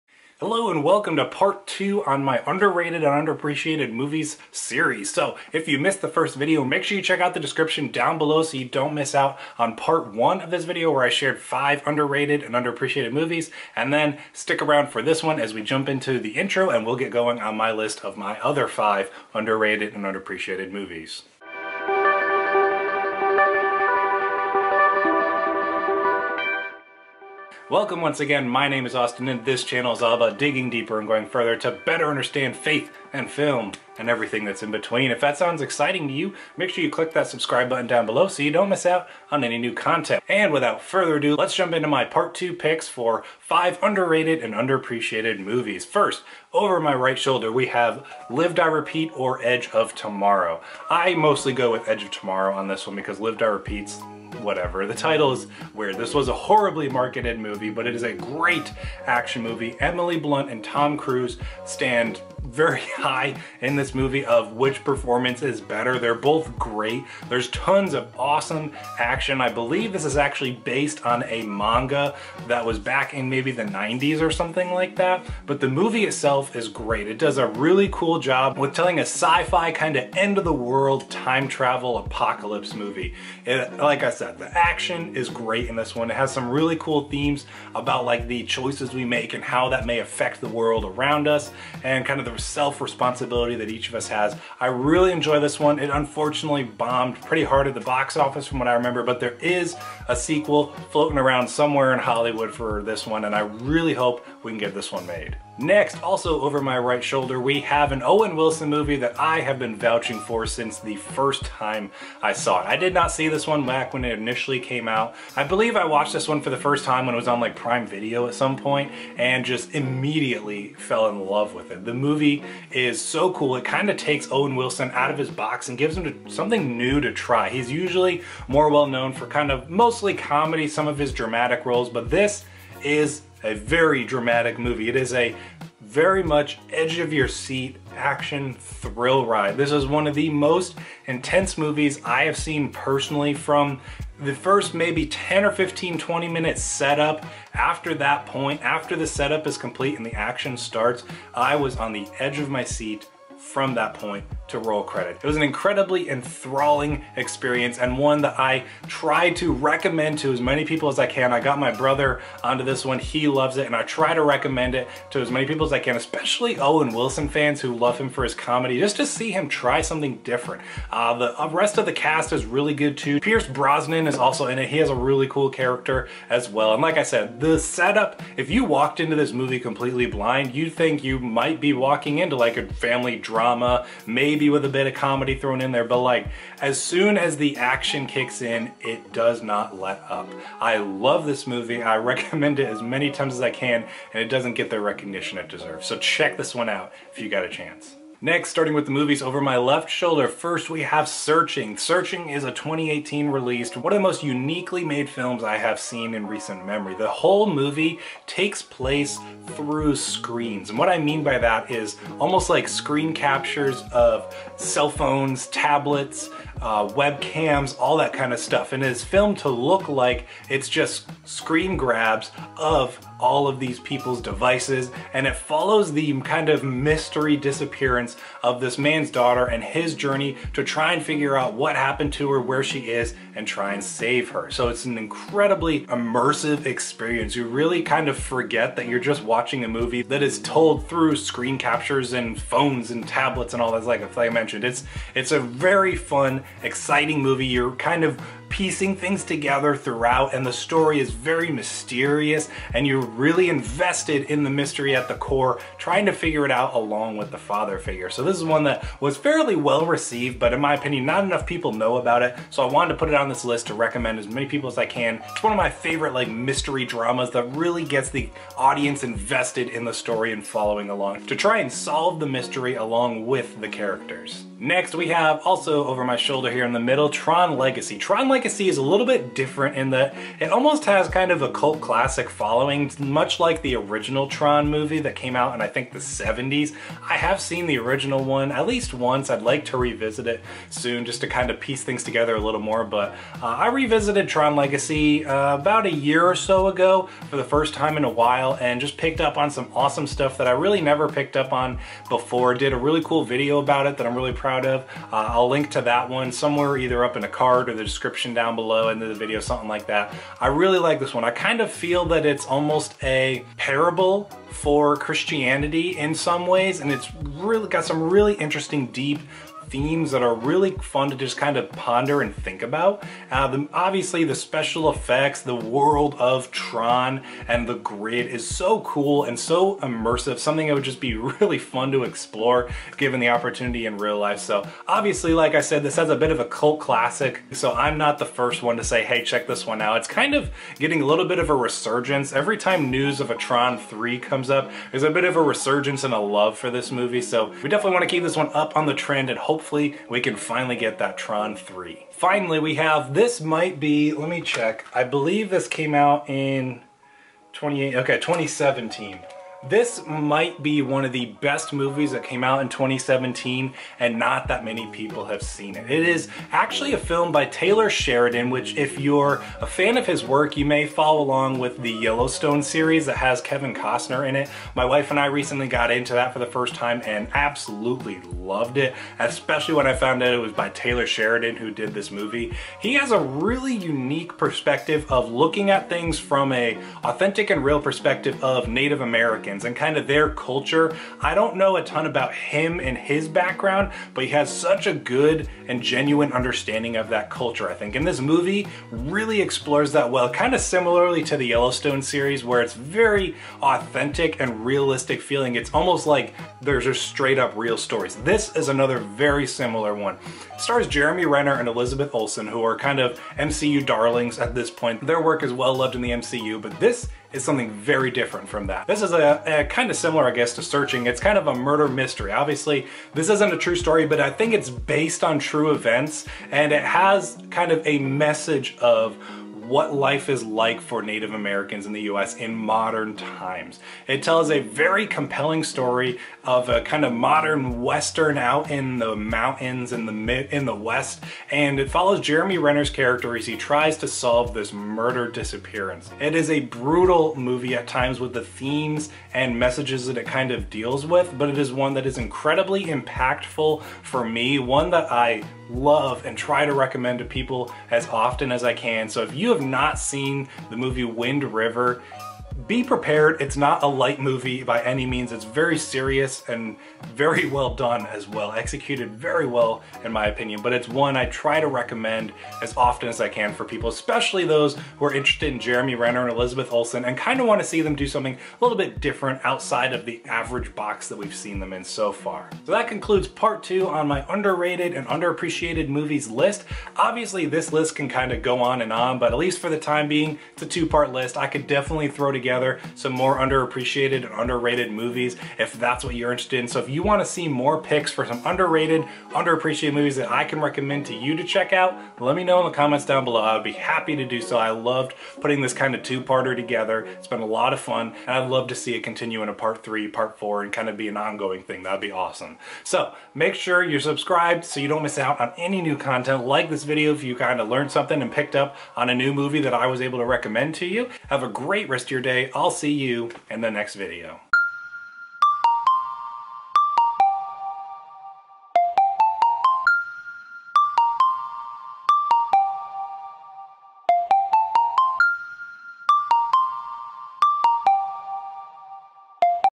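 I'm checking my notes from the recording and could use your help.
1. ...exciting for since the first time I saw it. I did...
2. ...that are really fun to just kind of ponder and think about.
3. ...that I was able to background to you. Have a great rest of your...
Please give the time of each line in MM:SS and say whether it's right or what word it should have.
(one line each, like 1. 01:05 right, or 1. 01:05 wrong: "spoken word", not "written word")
1. 01:49 wrong: "vouching", not "exciting"
2. 05:20 right
3. 08:39 wrong: "recommend", not "background".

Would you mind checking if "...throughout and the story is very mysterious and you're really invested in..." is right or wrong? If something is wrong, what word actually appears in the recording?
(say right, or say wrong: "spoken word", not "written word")
right.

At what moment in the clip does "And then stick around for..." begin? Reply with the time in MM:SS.
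00:13.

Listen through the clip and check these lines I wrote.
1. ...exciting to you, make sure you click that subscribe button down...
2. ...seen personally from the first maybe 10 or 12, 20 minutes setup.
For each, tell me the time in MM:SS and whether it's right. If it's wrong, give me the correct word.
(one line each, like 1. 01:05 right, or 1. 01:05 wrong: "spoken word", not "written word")
1. 00:35 right
2. 02:22 wrong: "15", not "12".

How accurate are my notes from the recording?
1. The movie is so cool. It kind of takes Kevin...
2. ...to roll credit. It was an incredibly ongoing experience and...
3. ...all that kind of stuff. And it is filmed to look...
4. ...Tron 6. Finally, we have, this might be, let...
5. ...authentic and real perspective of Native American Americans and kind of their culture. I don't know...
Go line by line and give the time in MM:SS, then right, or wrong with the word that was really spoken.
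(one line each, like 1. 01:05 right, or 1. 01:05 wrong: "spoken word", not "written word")
1. 02:01 wrong: "Owen", not "Kevin"
2. 02:34 wrong: "enthralling", not "ongoing"
3. 03:37 right
4. 05:51 wrong: "3", not "6"
5. 06:27 right.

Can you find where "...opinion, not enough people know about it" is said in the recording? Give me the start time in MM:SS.
04:20.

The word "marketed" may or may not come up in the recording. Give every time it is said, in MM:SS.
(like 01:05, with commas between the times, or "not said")
00:56.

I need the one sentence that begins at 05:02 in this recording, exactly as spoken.
Did a really cool video about it that I'm really proud of.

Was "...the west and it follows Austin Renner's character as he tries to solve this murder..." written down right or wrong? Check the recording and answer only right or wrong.
wrong.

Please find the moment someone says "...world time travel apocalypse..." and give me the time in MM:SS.
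01:20.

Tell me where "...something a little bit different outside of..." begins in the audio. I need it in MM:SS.
07:58.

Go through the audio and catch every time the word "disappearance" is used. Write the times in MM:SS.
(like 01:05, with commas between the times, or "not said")
03:47, 07:25.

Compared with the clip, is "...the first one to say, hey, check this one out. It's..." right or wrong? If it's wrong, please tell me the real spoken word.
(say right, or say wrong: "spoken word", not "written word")
right.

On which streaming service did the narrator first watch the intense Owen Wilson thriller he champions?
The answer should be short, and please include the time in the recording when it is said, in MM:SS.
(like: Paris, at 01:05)
Prime Video, at 01:57.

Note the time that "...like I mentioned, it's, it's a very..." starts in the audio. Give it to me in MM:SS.
04:04.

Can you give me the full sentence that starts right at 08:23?
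I would be happy to do so.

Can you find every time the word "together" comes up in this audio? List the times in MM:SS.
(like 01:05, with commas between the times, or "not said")
04:09, 04:52, 08:12, 08:26.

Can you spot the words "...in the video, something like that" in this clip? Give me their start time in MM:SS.
05:08.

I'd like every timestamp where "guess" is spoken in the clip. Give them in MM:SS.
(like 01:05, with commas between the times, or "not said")
07:00.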